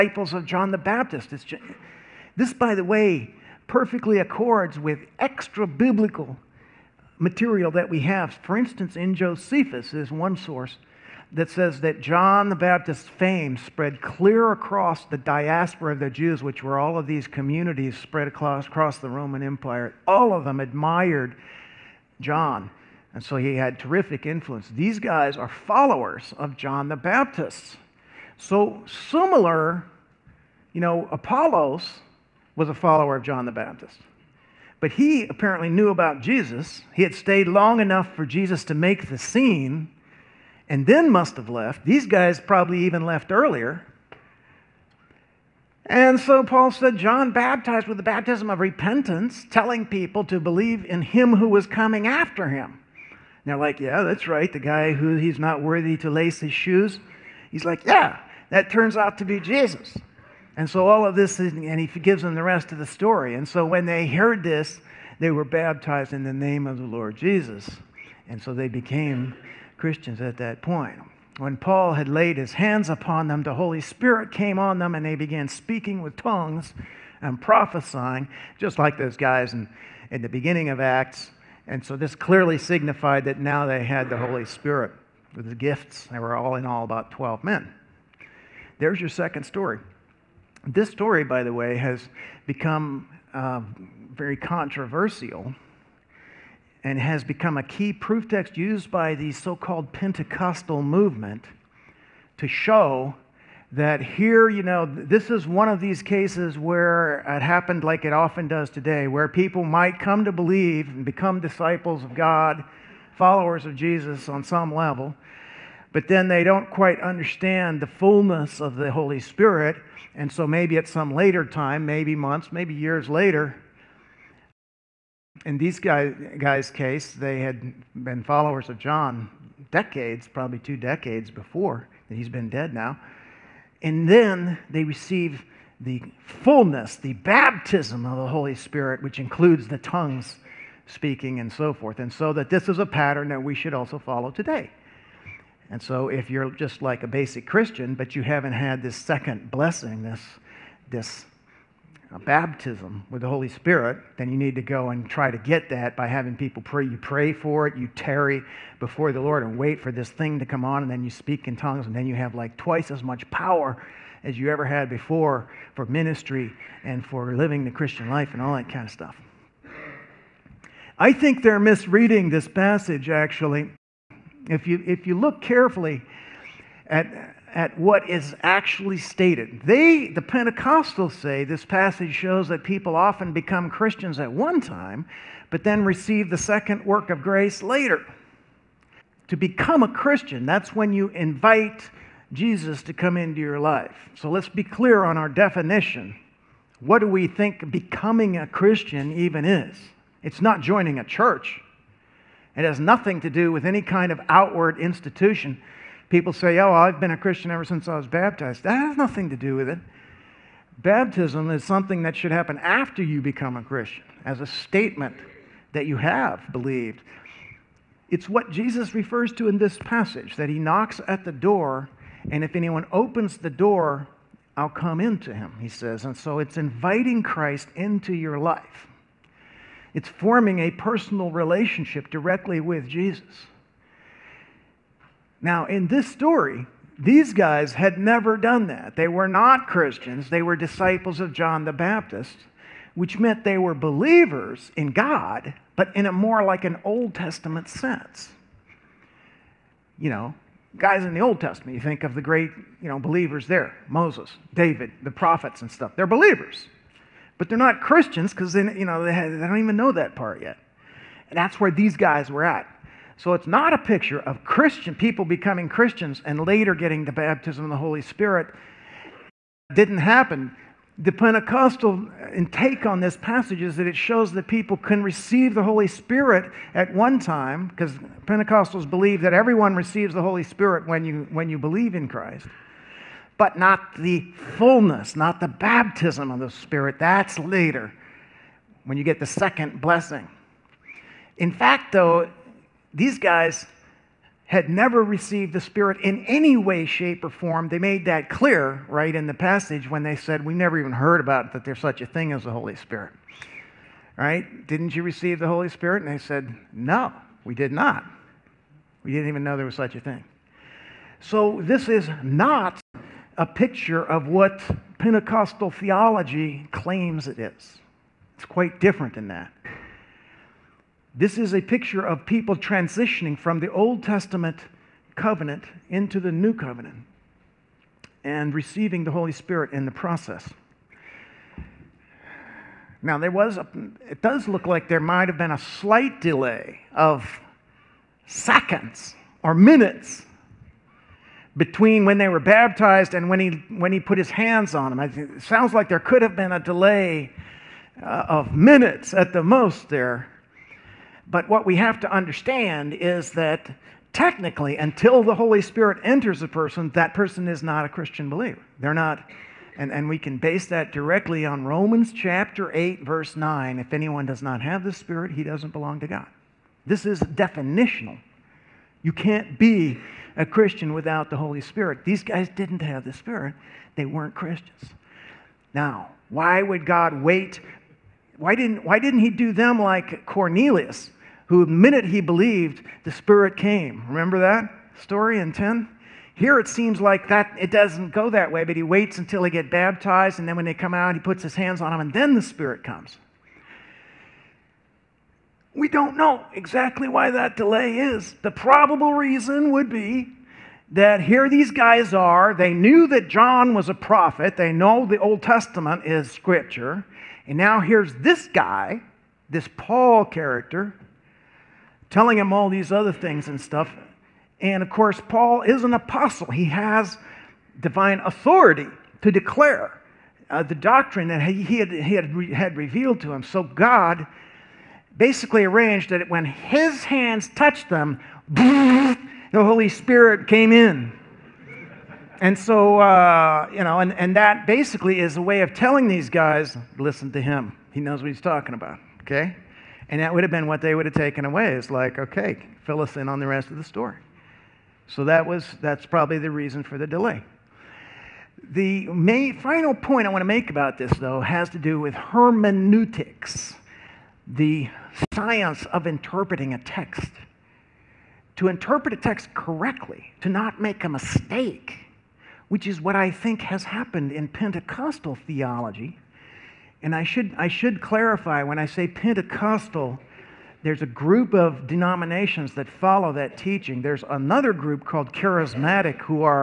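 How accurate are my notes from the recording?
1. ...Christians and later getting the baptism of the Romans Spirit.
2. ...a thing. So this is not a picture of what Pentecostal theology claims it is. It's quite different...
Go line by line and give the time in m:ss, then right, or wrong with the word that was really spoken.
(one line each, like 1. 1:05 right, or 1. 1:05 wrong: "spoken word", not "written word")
1. 4:25 wrong: "Holy", not "Romans"
2. 5:09 right.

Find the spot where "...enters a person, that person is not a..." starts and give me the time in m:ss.
5:56.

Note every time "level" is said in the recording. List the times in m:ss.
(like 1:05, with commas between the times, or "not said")
1:54.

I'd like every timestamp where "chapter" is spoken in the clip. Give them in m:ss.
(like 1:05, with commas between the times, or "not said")
6:02.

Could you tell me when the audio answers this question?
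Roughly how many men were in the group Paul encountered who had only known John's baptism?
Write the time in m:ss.
1:27.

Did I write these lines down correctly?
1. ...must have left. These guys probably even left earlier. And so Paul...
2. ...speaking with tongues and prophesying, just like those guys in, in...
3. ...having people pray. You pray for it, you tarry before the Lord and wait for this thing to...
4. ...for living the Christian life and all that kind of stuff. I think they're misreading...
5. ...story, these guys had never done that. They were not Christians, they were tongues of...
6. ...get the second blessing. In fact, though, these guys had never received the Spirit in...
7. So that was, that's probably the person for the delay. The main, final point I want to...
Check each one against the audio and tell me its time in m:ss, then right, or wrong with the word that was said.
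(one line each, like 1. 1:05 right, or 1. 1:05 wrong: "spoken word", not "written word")
1. 0:41 right
2. 1:15 right
3. 2:36 right
4. 2:47 right
5. 3:56 wrong: "disciples", not "tongues"
6. 4:49 right
7. 7:25 wrong: "reason", not "person".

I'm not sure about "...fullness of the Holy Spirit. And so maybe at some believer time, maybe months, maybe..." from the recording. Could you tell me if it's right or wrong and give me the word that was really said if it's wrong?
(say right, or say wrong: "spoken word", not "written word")
wrong: "later", not "believer".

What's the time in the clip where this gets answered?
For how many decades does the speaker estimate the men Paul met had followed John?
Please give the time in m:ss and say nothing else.
2:10.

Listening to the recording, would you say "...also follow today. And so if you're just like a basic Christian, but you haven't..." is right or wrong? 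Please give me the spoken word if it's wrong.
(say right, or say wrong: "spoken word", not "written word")
right.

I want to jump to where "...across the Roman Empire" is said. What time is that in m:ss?
0:18.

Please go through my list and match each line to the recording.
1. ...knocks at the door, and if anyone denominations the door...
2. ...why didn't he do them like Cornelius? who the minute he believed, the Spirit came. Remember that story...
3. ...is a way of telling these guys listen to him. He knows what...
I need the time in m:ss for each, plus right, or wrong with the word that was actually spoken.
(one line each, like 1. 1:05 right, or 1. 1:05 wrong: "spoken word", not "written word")
1. 3:40 wrong: "opens", not "denominations"
2. 6:18 right
3. 7:15 right.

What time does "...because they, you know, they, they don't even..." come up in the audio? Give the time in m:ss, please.
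4:18.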